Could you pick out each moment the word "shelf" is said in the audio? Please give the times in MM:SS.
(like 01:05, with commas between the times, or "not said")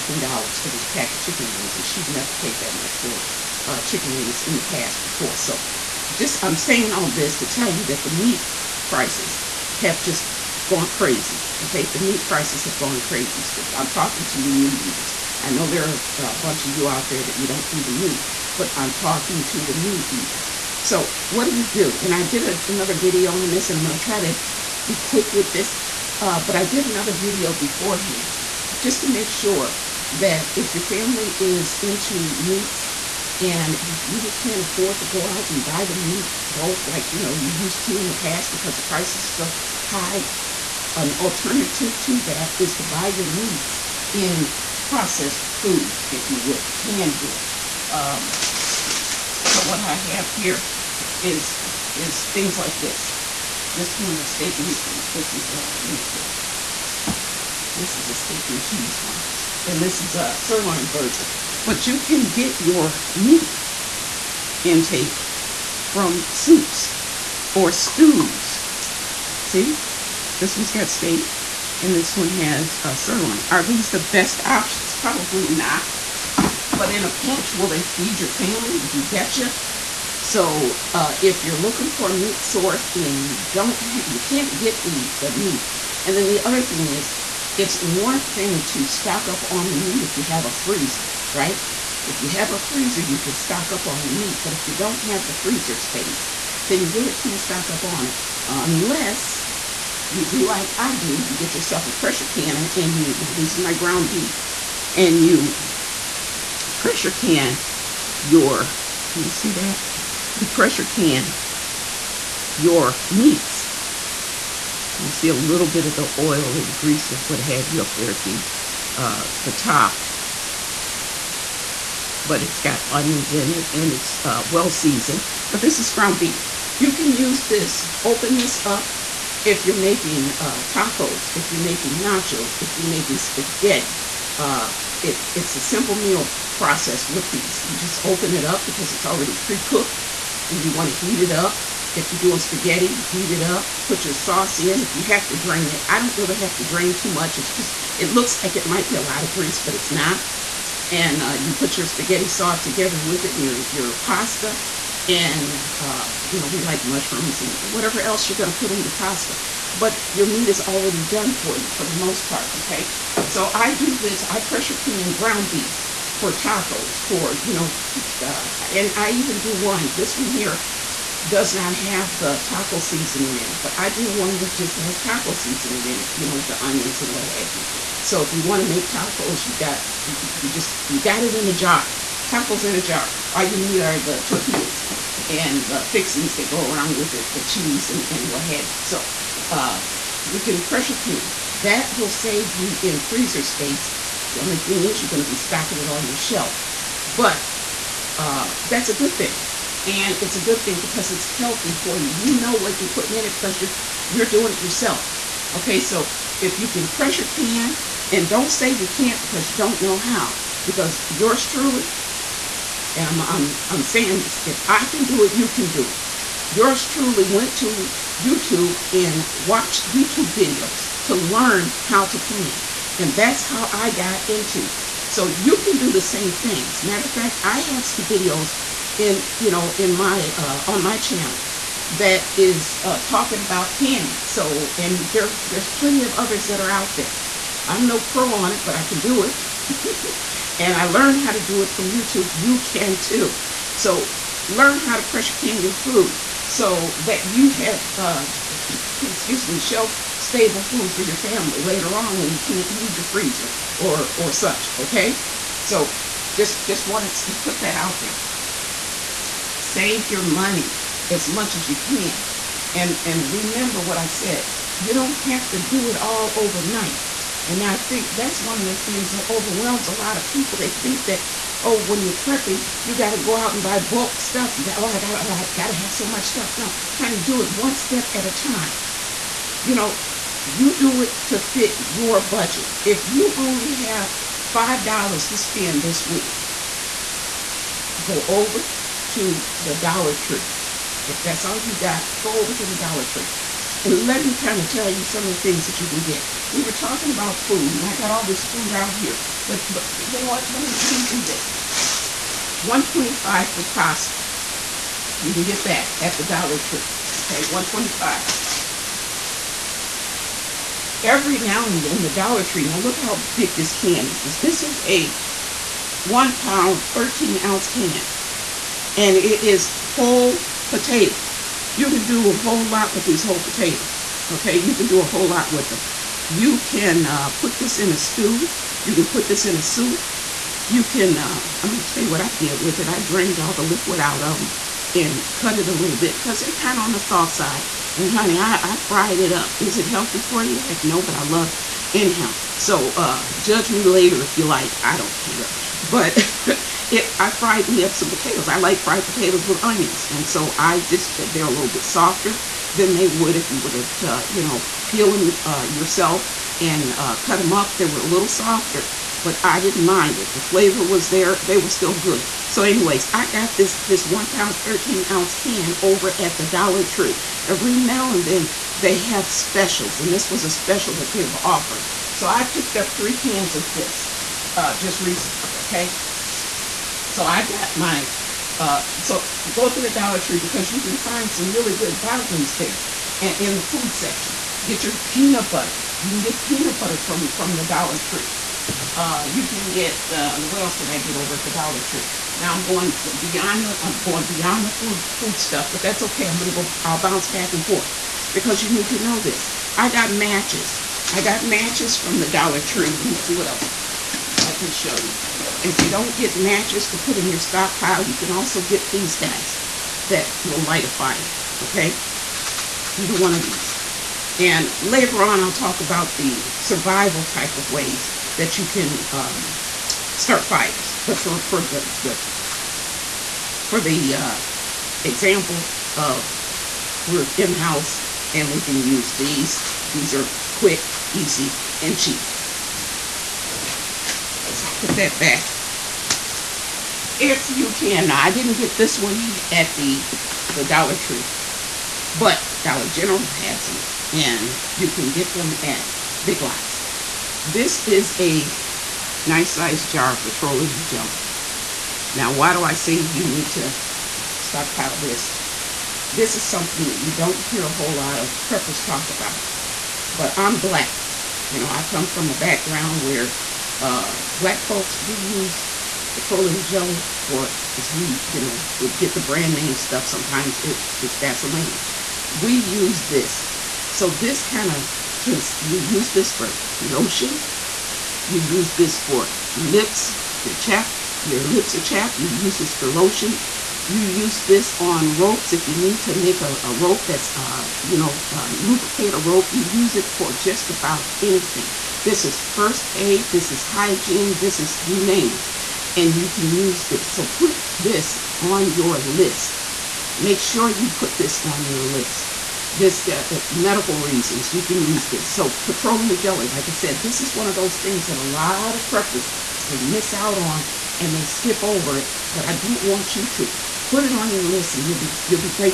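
03:16, 04:09.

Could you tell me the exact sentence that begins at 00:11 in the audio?
Okay, the meat prices have gone crazy.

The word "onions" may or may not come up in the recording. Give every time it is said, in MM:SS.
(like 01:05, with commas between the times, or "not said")
02:02, 02:56, 05:49.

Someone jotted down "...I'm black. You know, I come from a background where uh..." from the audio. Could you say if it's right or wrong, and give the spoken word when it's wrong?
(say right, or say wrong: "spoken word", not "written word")
right.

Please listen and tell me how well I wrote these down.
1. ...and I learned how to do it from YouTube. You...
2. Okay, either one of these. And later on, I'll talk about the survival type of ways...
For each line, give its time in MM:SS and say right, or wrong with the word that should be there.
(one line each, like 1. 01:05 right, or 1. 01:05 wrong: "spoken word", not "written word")
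1. 04:00 right
2. 06:51 right.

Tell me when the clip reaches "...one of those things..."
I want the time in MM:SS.
08:27.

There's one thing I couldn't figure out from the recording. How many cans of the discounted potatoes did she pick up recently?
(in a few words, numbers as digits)
3.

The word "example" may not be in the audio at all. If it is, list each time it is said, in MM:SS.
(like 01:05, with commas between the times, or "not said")
07:05.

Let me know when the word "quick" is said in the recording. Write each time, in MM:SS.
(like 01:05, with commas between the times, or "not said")
00:24, 07:10.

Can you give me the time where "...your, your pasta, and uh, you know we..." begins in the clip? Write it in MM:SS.
02:33.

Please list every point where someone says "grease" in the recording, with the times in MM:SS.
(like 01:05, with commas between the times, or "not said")
01:56, 02:29.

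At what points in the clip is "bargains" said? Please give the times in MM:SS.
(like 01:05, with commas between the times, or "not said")
06:22.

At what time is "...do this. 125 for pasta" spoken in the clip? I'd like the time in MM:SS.
05:01.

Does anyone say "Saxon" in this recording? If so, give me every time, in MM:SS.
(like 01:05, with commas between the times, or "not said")
not said.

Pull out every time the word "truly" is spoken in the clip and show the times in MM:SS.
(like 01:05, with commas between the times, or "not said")
03:31, 03:36.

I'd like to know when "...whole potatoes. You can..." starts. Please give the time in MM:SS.
05:19.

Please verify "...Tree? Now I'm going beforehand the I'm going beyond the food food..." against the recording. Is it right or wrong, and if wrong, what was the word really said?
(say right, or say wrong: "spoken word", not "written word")
wrong: "beyond", not "beforehand".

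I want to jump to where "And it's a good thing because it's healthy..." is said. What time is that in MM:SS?
03:19.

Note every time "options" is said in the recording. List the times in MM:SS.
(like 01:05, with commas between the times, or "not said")
01:14.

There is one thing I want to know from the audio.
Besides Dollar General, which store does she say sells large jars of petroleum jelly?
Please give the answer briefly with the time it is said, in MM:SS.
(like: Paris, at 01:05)
Big Lots, at 07:26.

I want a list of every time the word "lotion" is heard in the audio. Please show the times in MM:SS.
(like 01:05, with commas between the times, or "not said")
07:56, 08:02.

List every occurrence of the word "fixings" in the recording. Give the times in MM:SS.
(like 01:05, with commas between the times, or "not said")
03:05.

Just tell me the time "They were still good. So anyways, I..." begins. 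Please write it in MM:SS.
06:01.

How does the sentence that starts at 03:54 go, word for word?
So, and there's, there's plenty of others that are out there.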